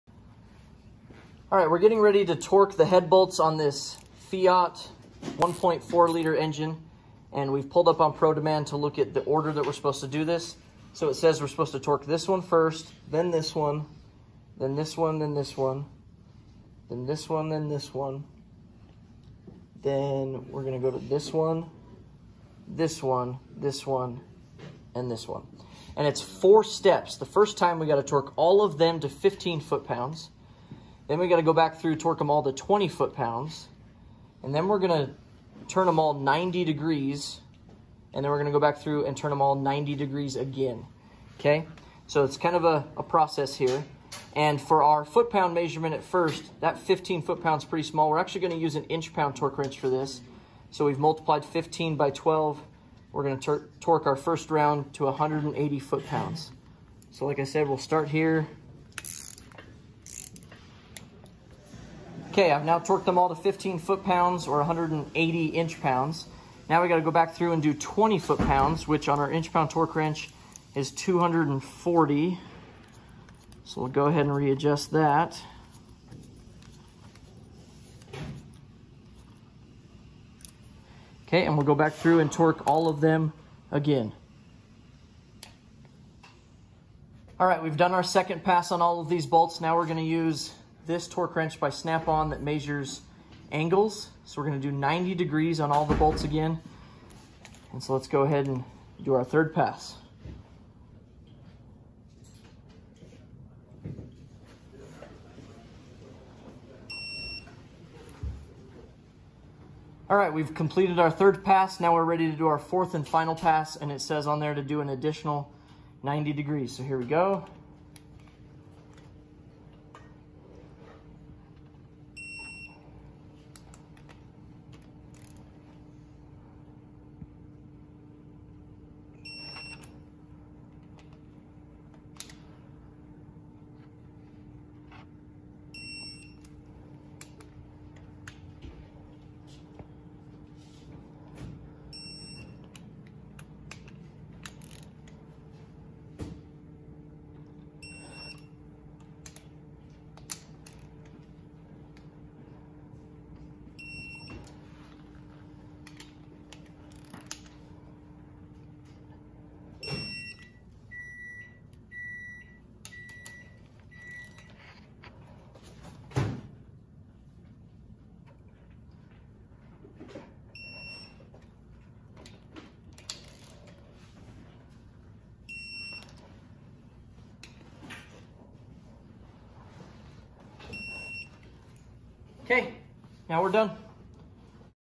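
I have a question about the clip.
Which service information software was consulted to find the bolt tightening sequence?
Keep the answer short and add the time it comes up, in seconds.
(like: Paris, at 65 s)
ProDemand, at 8 s.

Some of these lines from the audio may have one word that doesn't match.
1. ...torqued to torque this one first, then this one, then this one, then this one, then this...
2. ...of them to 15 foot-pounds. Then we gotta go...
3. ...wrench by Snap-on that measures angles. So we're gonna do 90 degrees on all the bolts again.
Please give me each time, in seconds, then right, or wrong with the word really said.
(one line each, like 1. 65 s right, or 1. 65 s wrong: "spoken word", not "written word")
1. 11 s wrong: "supposed", not "torqued"
2. 28 s right
3. 91 s right.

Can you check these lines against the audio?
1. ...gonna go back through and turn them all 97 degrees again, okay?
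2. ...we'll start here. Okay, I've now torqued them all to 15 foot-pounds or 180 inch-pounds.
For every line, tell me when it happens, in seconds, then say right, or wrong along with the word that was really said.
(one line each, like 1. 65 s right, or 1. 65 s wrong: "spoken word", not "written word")
1. 38 s wrong: "90", not "97"
2. 57 s right.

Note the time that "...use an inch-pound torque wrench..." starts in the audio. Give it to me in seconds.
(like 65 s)
48 s.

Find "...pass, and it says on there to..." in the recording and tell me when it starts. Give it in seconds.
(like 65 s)
113 s.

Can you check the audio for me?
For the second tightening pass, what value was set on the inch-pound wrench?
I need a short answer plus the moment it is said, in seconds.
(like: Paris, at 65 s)
240, at 70 s.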